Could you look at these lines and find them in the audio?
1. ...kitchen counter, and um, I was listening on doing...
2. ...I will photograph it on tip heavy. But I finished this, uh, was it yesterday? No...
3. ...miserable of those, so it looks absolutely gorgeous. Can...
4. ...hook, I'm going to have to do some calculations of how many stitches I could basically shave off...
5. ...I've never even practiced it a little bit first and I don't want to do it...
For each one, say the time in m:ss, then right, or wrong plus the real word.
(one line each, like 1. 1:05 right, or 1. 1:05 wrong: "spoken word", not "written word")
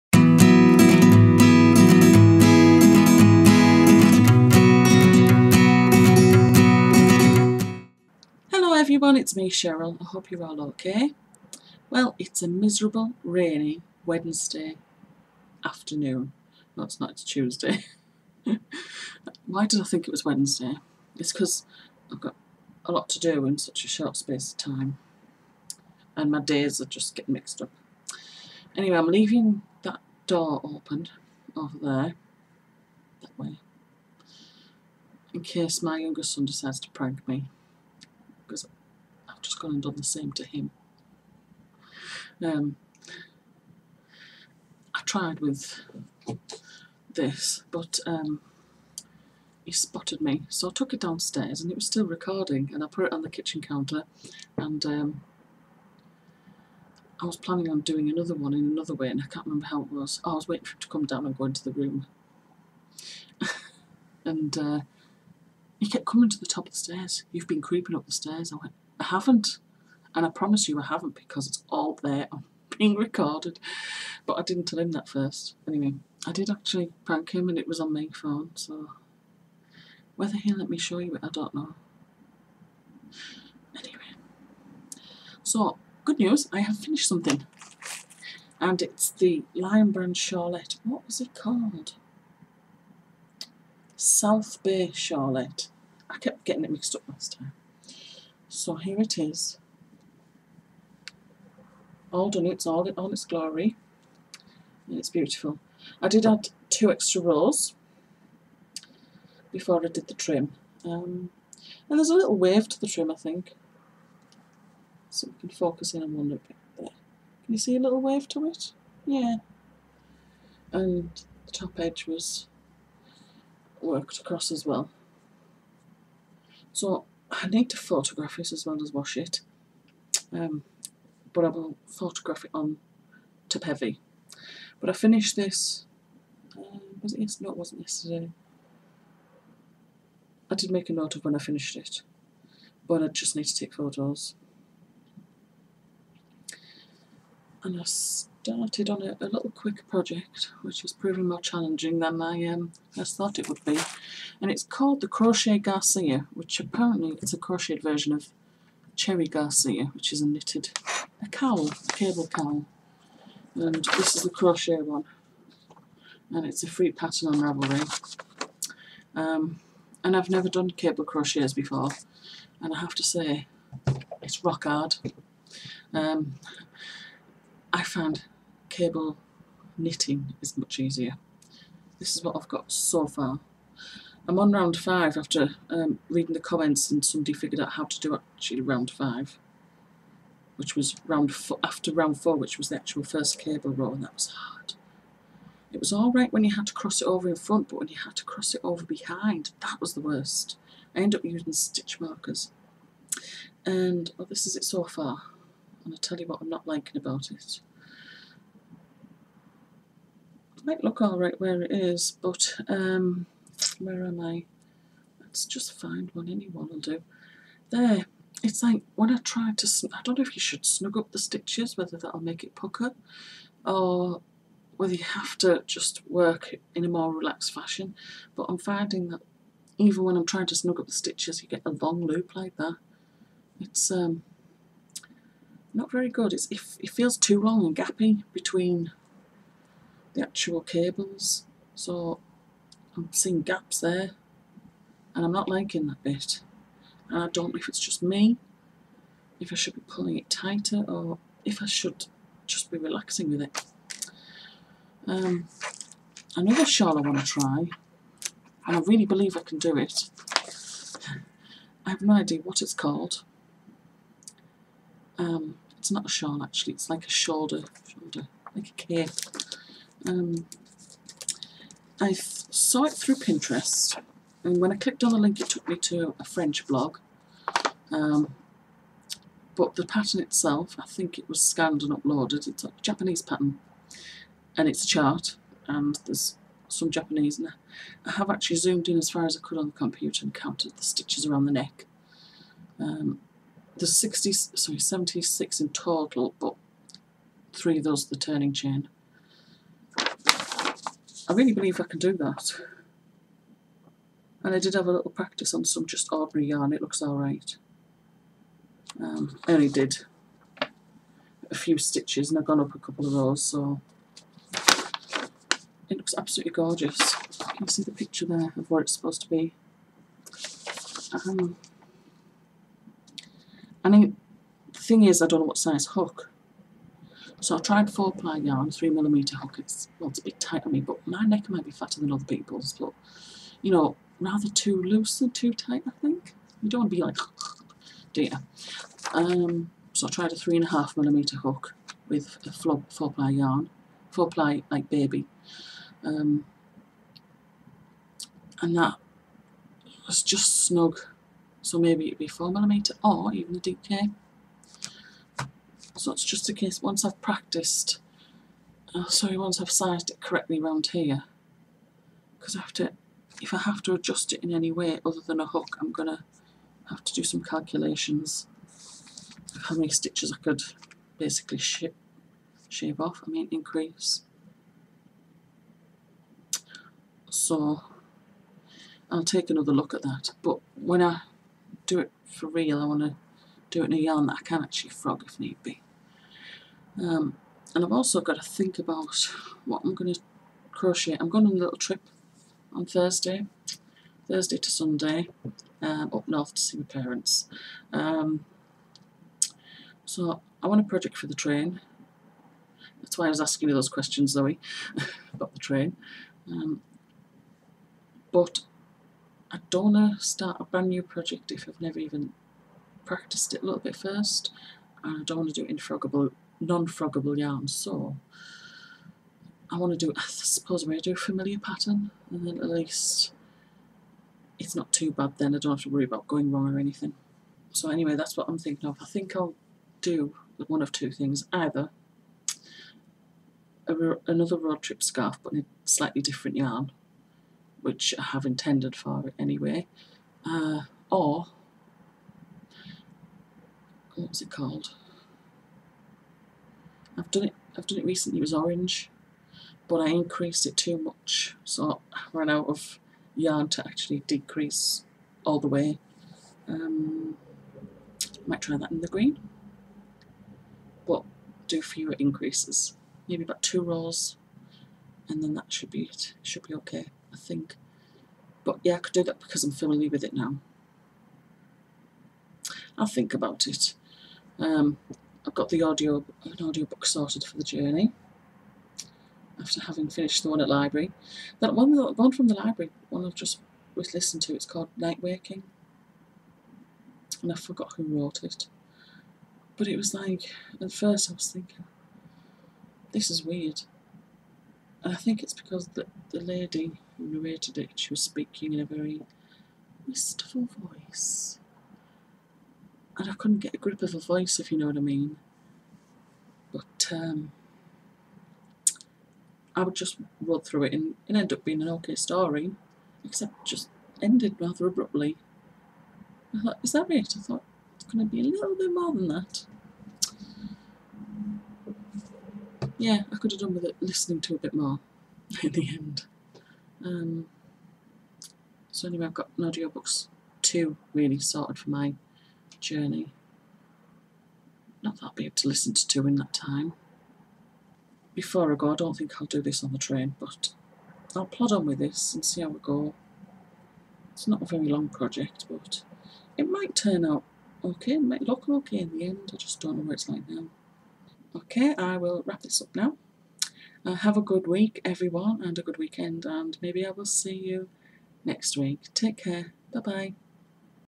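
1. 0:53 wrong: "planning", not "listening"
2. 2:11 right
3. 5:12 wrong: "couple", not "miserable"
4. 6:05 right
5. 6:51 right.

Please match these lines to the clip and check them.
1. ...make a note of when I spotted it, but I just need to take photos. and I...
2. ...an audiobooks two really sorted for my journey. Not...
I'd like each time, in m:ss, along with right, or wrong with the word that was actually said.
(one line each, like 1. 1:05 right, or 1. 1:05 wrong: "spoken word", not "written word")
1. 2:20 wrong: "finished", not "spotted"
2. 8:49 right.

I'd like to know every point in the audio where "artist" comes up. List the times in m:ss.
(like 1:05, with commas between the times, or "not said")
not said.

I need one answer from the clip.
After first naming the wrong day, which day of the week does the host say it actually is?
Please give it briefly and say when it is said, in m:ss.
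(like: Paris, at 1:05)
Tuesday, at 0:17.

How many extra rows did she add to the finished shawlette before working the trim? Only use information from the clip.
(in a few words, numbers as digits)
2.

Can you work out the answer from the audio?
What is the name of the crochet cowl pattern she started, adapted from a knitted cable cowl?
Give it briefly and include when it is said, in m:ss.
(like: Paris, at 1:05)
Crochet Garcia, at 2:35.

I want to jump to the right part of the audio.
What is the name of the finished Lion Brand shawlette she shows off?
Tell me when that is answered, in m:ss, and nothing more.
1:33.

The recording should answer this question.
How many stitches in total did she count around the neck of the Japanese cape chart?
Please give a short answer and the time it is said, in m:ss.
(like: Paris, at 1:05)
76, at 4:54.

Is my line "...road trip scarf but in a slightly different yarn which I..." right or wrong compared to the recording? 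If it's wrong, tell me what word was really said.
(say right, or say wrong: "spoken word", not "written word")
right.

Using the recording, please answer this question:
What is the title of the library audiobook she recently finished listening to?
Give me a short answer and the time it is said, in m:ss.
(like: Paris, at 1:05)
Night Waking, at 8:04.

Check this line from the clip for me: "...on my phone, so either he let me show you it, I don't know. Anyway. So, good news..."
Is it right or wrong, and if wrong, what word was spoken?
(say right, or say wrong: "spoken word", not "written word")
wrong: "whether", not "either".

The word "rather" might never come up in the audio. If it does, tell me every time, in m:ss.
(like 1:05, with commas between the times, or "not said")
5:34, 8:34.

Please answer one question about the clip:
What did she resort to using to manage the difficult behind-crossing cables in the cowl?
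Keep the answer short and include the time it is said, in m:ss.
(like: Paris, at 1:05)
Stitch markers, at 3:21.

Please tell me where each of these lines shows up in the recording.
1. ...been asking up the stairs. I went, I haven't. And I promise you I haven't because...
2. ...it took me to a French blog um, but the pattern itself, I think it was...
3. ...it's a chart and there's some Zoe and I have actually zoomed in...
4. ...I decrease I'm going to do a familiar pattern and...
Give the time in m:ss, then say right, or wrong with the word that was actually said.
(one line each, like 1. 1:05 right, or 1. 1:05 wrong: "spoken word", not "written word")
1. 1:07 wrong: "creeping", not "asking"
2. 4:35 right
3. 4:44 wrong: "Japanese", not "Zoe"
4. 7:00 wrong: "suppose", not "decrease".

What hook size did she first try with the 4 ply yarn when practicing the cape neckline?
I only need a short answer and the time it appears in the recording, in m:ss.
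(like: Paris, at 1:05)
3 millimeter, at 5:28.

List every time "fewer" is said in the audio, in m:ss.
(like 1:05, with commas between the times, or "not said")
7:41.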